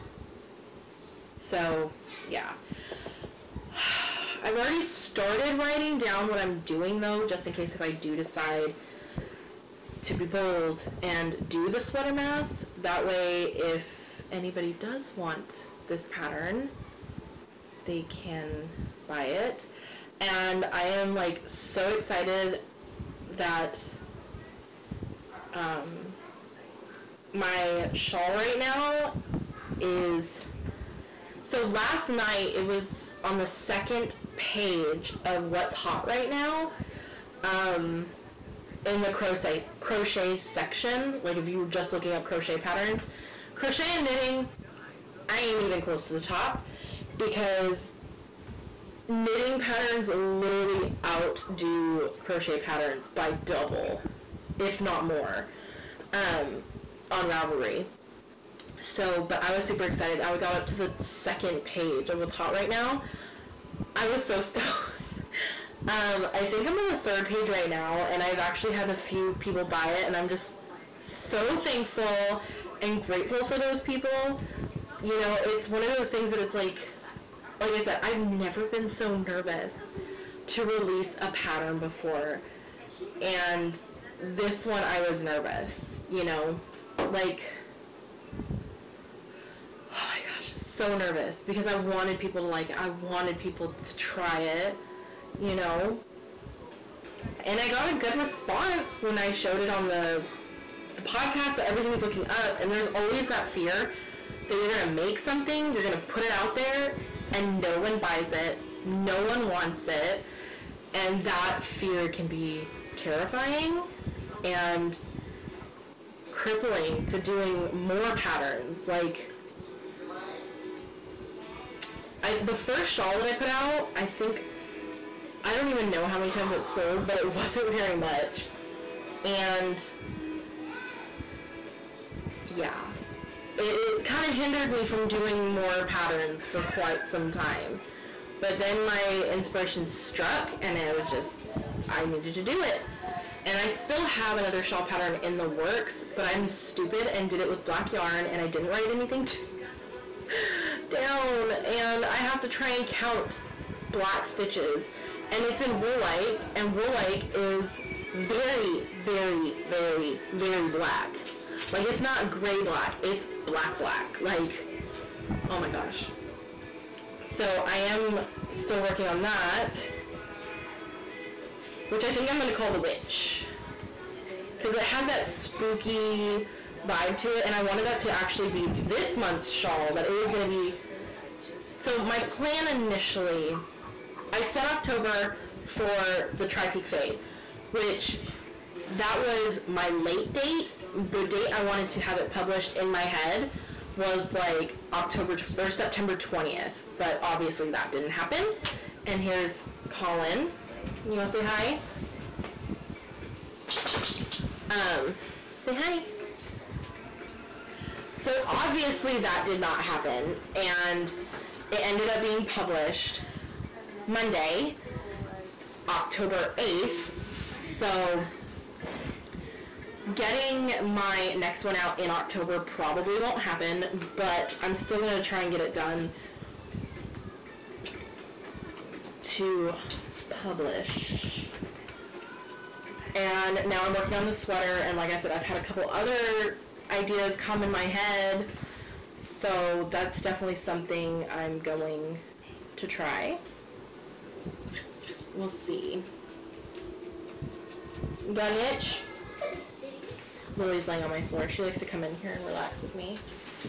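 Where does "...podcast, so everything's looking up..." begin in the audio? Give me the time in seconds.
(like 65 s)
101 s.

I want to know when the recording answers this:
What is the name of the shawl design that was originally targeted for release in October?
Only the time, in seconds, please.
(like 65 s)
186 s.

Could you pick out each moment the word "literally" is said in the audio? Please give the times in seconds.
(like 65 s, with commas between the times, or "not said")
50 s.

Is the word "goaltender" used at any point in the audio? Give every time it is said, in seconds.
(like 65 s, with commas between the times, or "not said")
not said.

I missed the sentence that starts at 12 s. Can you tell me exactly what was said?
That way, if anybody does want this pattern, they can buy it.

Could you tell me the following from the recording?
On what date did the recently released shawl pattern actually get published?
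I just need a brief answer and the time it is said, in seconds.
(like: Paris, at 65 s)
Monday, October 8th, at 214 s.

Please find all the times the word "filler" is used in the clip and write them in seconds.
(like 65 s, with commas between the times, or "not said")
not said.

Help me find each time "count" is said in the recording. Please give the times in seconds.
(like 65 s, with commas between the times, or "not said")
152 s.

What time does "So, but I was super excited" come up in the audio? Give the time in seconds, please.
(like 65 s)
58 s.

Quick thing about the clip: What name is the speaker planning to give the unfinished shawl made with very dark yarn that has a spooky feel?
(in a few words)
The Witch.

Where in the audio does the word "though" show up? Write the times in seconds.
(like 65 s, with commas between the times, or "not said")
7 s.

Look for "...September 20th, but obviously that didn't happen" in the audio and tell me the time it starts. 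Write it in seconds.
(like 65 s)
195 s.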